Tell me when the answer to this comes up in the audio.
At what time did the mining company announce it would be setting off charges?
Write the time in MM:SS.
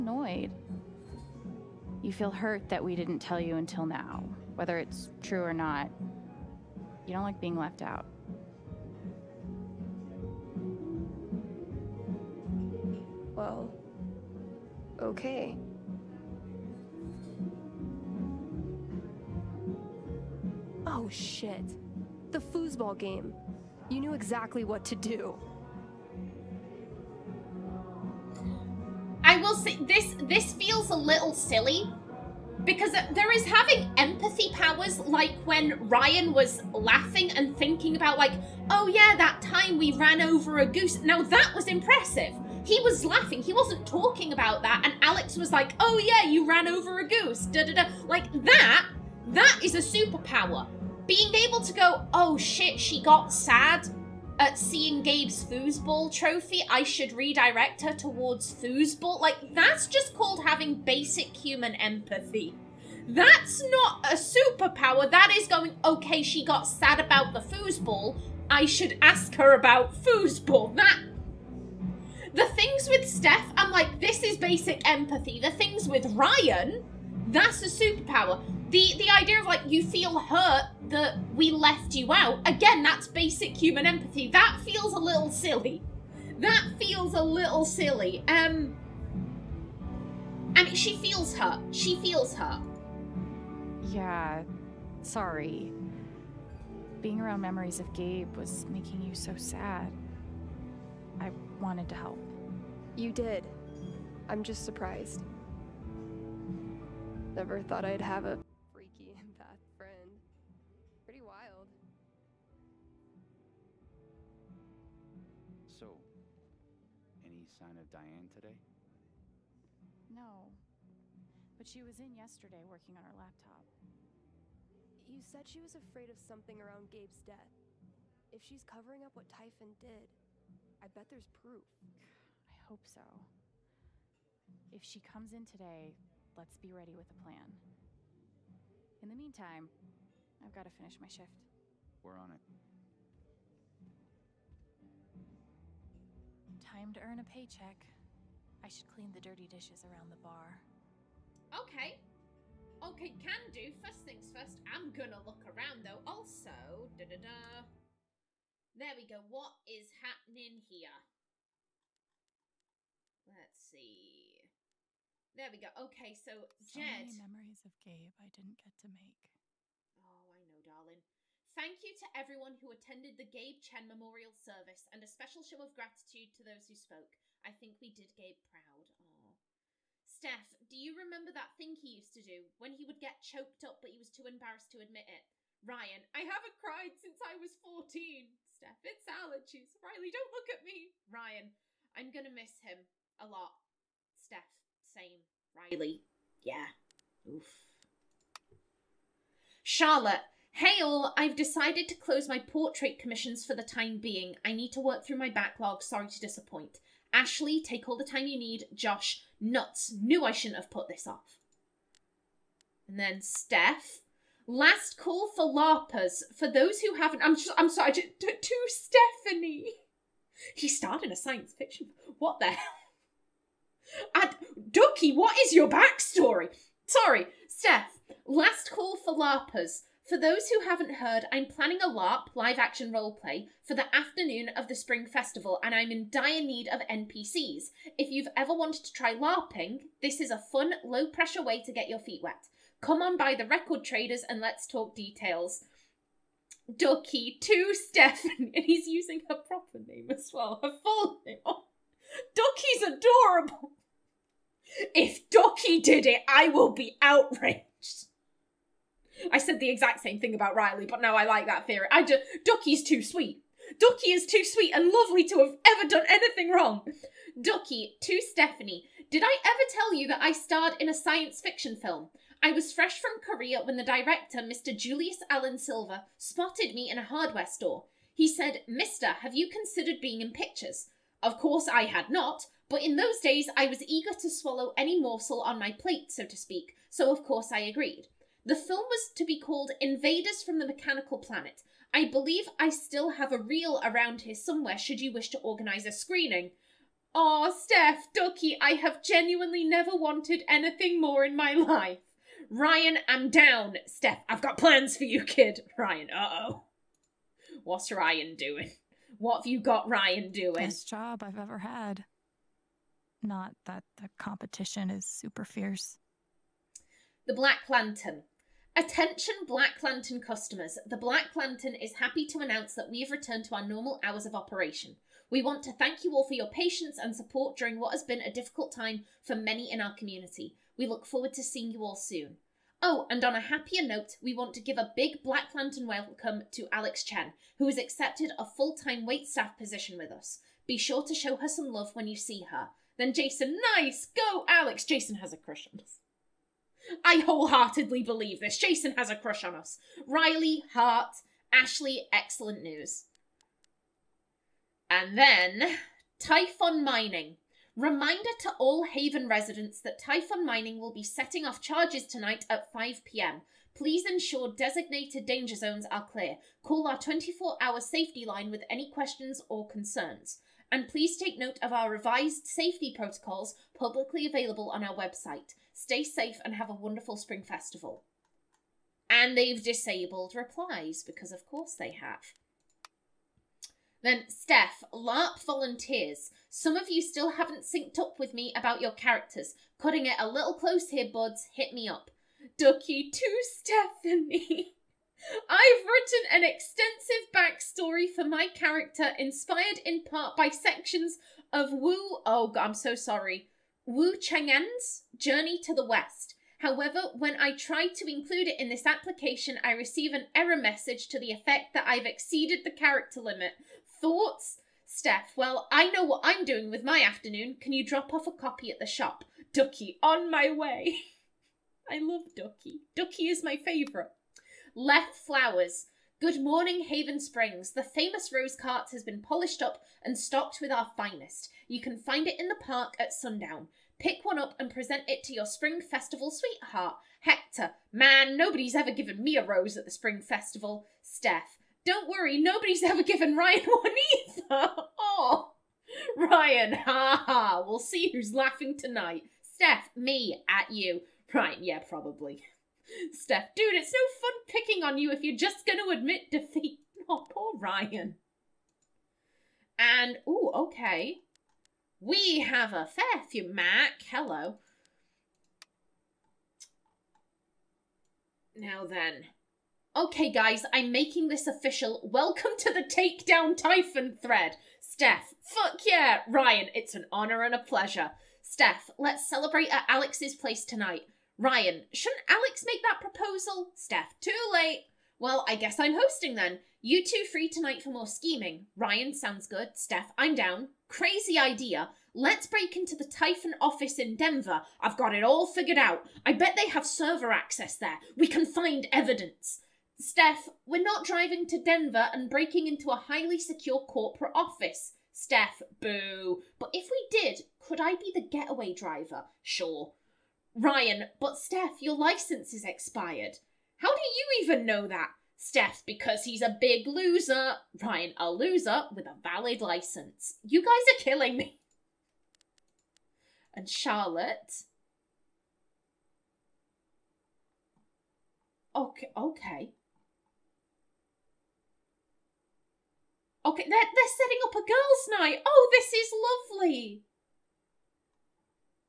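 06:02.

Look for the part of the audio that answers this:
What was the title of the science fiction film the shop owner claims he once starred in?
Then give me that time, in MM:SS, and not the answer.
04:49.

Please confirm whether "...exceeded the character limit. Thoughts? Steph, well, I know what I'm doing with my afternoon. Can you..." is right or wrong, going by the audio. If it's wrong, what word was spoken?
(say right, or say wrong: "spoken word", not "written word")
right.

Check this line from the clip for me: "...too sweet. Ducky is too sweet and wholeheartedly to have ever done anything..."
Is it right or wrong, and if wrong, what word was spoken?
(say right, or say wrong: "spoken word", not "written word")
wrong: "lovely", not "wholeheartedly".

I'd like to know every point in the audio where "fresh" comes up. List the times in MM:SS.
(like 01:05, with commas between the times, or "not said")
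04:32.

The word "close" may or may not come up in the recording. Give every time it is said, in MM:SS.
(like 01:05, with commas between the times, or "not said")
03:21, 06:30.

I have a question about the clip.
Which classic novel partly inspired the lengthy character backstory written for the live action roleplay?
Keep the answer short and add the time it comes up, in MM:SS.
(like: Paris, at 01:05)
Journey to the West, at 06:45.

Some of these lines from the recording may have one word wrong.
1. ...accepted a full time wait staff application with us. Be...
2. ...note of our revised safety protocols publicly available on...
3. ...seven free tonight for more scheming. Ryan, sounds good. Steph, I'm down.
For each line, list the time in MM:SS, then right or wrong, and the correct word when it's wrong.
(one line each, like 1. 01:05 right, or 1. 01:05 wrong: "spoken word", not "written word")
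1. 05:37 wrong: "position", not "application"
2. 06:11 right
3. 08:07 wrong: "two", not "seven".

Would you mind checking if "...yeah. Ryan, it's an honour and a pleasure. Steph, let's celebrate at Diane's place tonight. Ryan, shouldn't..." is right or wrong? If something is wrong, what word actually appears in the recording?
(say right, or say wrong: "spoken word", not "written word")
wrong: "Alex", not "Diane".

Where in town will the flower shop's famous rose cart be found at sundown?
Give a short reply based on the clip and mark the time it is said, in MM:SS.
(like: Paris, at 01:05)
the park, at 07:12.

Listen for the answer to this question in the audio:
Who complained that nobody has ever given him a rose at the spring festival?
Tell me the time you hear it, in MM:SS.
07:17.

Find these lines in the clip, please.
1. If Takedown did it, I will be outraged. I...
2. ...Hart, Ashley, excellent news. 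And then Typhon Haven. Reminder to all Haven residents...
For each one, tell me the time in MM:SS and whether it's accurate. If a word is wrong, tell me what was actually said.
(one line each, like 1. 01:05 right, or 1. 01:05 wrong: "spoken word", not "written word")
1. 04:14 wrong: "Ducky", not "Takedown"
2. 05:50 wrong: "Mining", not "Haven".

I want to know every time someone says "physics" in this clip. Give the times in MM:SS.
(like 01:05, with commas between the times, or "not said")
not said.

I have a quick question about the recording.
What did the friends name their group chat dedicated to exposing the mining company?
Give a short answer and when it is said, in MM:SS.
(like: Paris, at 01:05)
Takedown Typhon thread, at 07:52.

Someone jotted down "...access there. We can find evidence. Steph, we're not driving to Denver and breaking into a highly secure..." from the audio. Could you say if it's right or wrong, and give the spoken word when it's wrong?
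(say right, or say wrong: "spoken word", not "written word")
right.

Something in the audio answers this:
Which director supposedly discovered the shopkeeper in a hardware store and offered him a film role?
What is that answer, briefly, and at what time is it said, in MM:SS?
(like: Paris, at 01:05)
Julius Allen Silver, at 04:34.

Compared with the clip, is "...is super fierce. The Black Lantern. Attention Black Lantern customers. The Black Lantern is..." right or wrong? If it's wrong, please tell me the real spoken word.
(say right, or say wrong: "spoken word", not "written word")
right.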